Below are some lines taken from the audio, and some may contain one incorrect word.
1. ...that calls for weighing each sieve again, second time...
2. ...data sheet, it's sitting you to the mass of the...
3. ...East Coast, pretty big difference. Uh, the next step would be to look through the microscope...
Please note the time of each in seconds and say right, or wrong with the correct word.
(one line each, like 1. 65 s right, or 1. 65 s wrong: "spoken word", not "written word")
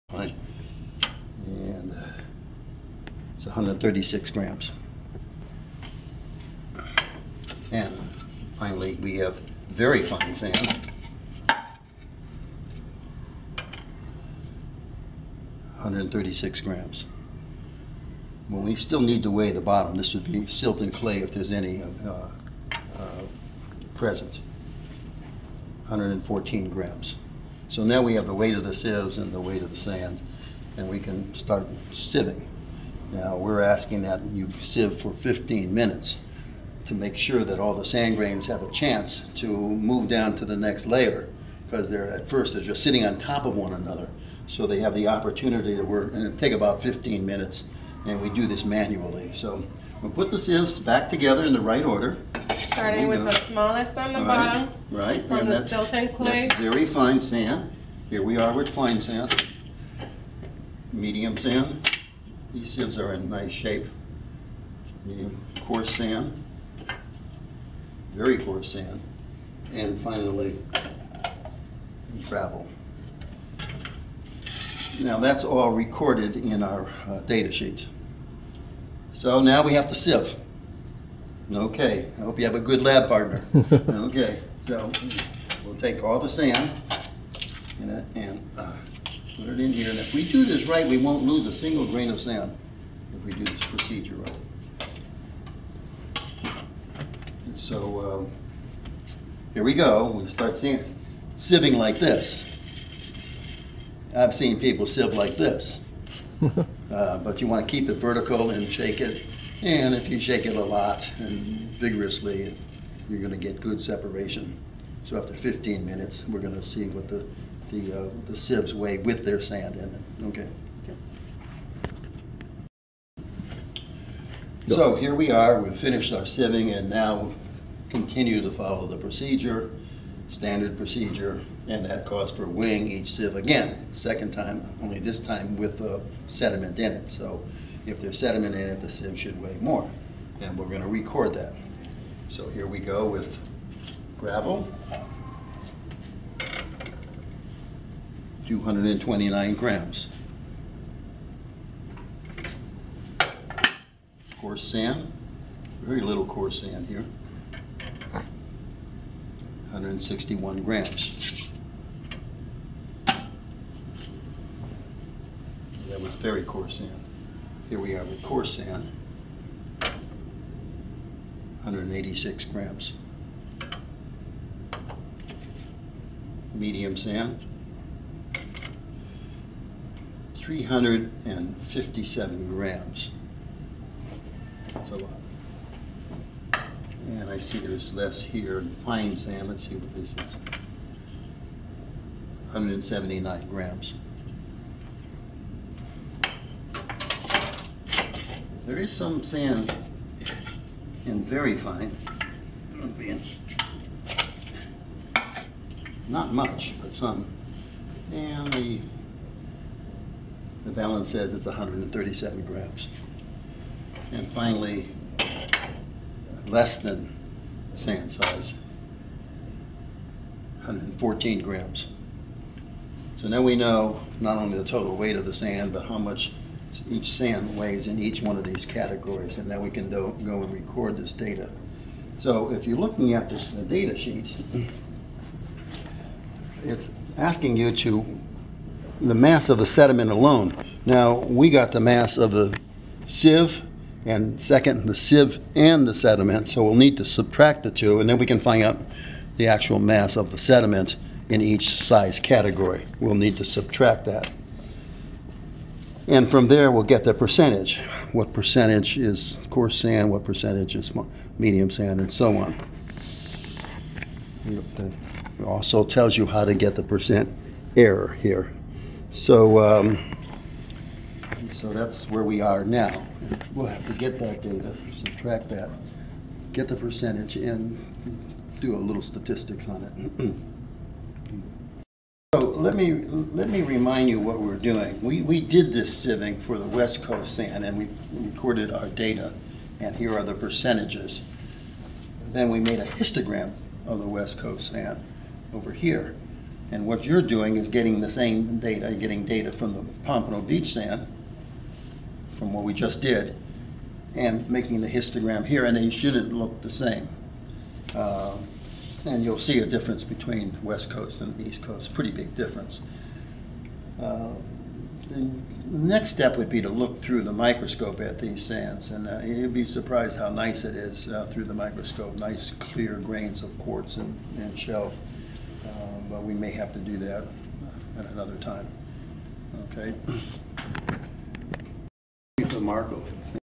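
1. 131 s right
2. 233 s wrong: "asking", not "sitting"
3. 311 s right.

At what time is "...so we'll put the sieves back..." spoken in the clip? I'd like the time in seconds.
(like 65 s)
49 s.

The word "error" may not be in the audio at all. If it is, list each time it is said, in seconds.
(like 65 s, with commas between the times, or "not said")
267 s.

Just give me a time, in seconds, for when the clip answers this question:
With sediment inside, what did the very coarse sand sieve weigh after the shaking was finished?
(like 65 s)
159 s.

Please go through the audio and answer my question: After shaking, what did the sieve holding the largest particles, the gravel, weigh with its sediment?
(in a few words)
229 grams.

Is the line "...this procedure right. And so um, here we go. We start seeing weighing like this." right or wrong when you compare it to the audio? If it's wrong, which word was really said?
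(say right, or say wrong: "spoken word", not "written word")
wrong: "sieving", not "weighing".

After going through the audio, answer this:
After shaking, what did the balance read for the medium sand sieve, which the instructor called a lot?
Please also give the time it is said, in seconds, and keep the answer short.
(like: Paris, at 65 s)
357 grams, at 180 s.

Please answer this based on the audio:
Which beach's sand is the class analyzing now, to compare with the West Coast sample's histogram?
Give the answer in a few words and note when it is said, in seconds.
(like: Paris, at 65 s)
Pompano Beach, at 300 s.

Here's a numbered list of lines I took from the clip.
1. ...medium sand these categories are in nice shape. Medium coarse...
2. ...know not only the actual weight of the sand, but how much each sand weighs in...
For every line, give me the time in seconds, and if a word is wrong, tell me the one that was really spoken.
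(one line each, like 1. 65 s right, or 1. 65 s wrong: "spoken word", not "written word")
1. 60 s wrong: "sieves", not "categories"
2. 223 s wrong: "total", not "actual".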